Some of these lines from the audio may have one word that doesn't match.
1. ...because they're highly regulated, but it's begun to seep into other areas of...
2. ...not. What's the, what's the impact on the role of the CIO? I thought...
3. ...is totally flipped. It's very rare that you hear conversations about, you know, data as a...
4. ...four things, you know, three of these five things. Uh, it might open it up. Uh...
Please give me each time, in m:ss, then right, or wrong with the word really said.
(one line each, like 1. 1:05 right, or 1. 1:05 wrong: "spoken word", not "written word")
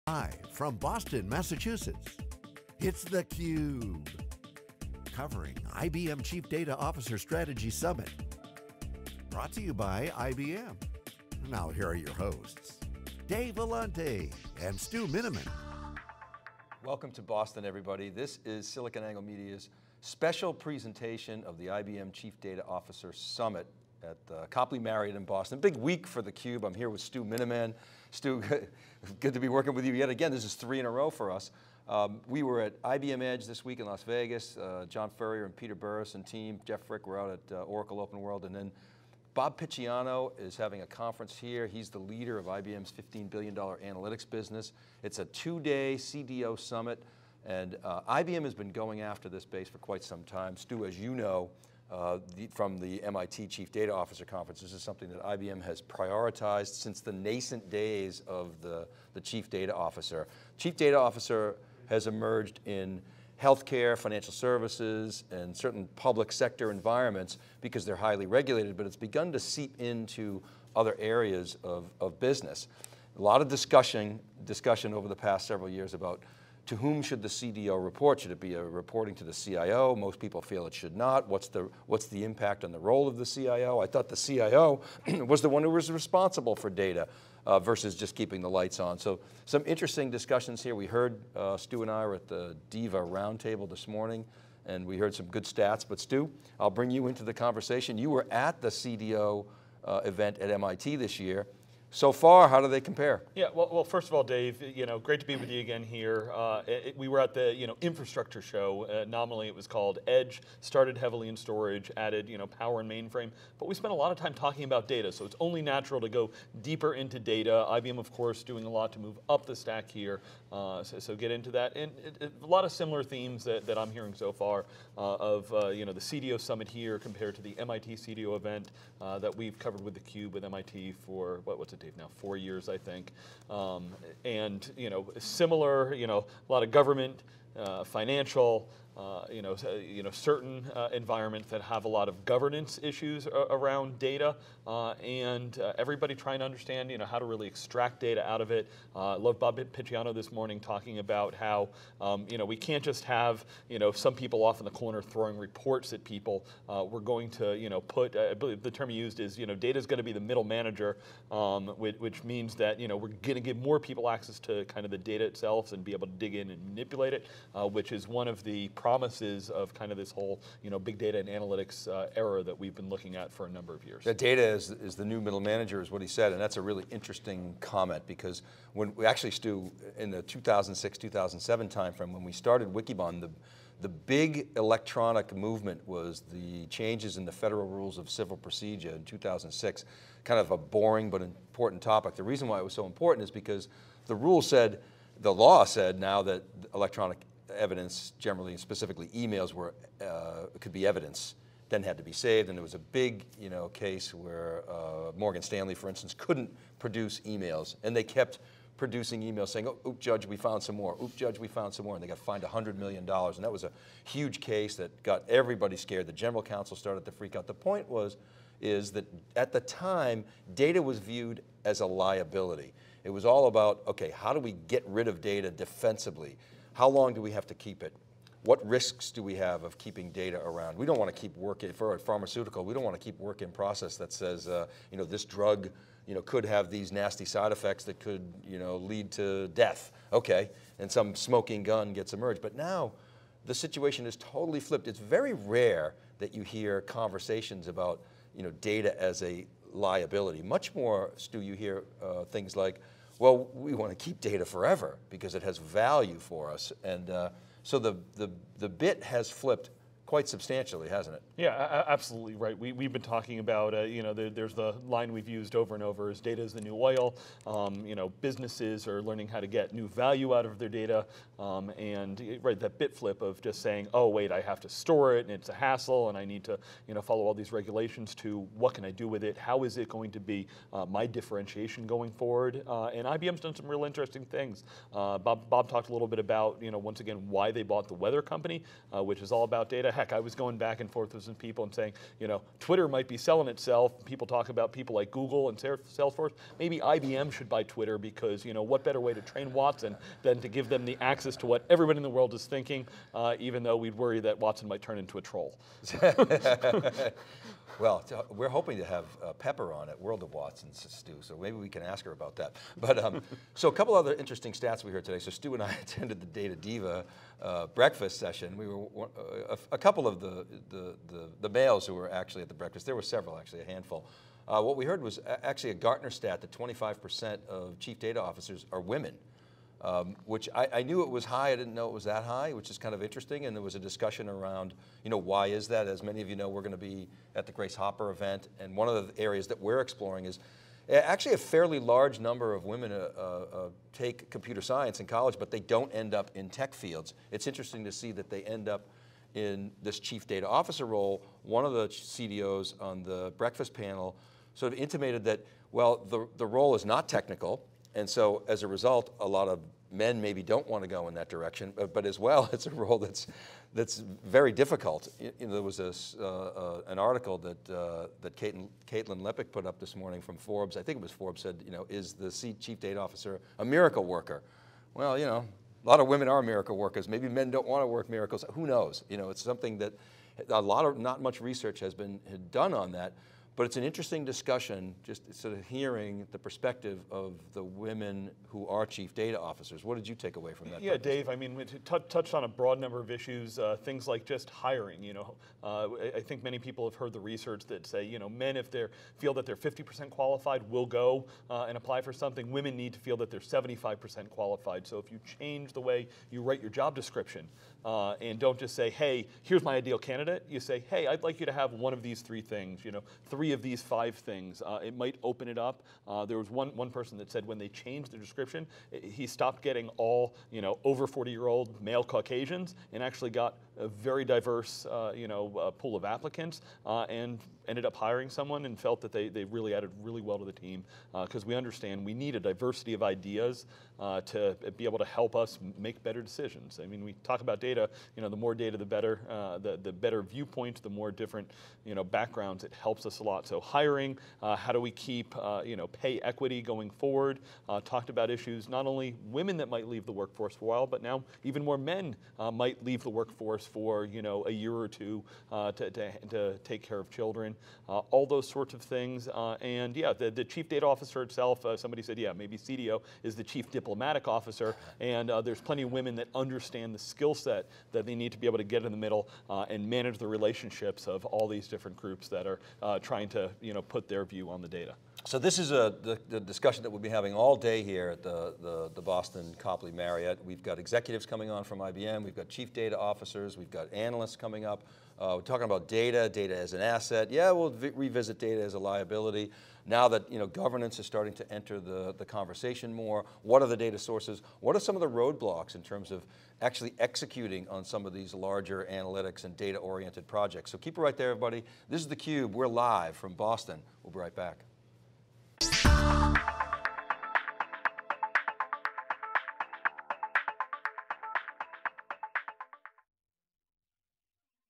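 1. 1:07 right
2. 1:20 right
3. 4:04 right
4. 6:52 wrong: "three", not "four".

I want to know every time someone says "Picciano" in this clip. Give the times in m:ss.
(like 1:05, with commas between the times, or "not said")
0:39, 2:29.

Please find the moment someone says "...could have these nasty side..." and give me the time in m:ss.
3:56.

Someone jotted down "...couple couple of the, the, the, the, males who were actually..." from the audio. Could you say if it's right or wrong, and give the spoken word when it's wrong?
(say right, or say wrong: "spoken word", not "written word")
right.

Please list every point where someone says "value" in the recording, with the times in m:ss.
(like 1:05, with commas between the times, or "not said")
4:15, 4:29.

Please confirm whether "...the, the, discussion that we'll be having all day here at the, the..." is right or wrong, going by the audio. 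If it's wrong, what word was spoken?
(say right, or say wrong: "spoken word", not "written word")
right.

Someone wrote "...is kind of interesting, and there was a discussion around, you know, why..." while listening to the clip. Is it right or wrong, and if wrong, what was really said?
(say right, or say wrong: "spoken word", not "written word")
right.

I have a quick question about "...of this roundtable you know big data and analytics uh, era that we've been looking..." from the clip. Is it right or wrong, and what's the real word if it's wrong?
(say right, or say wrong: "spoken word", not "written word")
wrong: "whole", not "roundtable".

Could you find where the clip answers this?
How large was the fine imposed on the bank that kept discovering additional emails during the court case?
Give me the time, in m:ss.
3:32.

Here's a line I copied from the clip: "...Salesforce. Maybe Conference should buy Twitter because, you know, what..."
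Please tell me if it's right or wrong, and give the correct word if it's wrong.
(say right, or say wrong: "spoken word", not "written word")
wrong: "IBM", not "Conference".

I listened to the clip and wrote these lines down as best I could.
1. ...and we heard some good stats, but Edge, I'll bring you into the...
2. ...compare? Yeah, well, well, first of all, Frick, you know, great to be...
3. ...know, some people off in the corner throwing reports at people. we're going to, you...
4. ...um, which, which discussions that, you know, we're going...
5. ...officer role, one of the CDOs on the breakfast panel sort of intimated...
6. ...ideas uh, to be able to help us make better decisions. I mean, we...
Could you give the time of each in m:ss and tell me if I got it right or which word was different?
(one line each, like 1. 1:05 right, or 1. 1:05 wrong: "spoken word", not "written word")
1. 1:34 wrong: "Stu", not "Edge"
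2. 1:42 wrong: "Dave", not "Frick"
3. 2:33 right
4. 2:41 wrong: "means", not "discussions"
5. 5:50 right
6. 7:13 right.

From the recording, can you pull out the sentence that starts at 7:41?
Uh, somebody said, yeah, maybe CDO is the chief diplomatic officer.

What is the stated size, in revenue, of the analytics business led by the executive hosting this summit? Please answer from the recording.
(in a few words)
$15 billion.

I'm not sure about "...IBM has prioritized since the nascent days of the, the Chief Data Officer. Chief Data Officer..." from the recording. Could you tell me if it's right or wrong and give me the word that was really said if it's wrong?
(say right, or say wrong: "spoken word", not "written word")
right.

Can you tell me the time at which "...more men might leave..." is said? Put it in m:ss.
7:31.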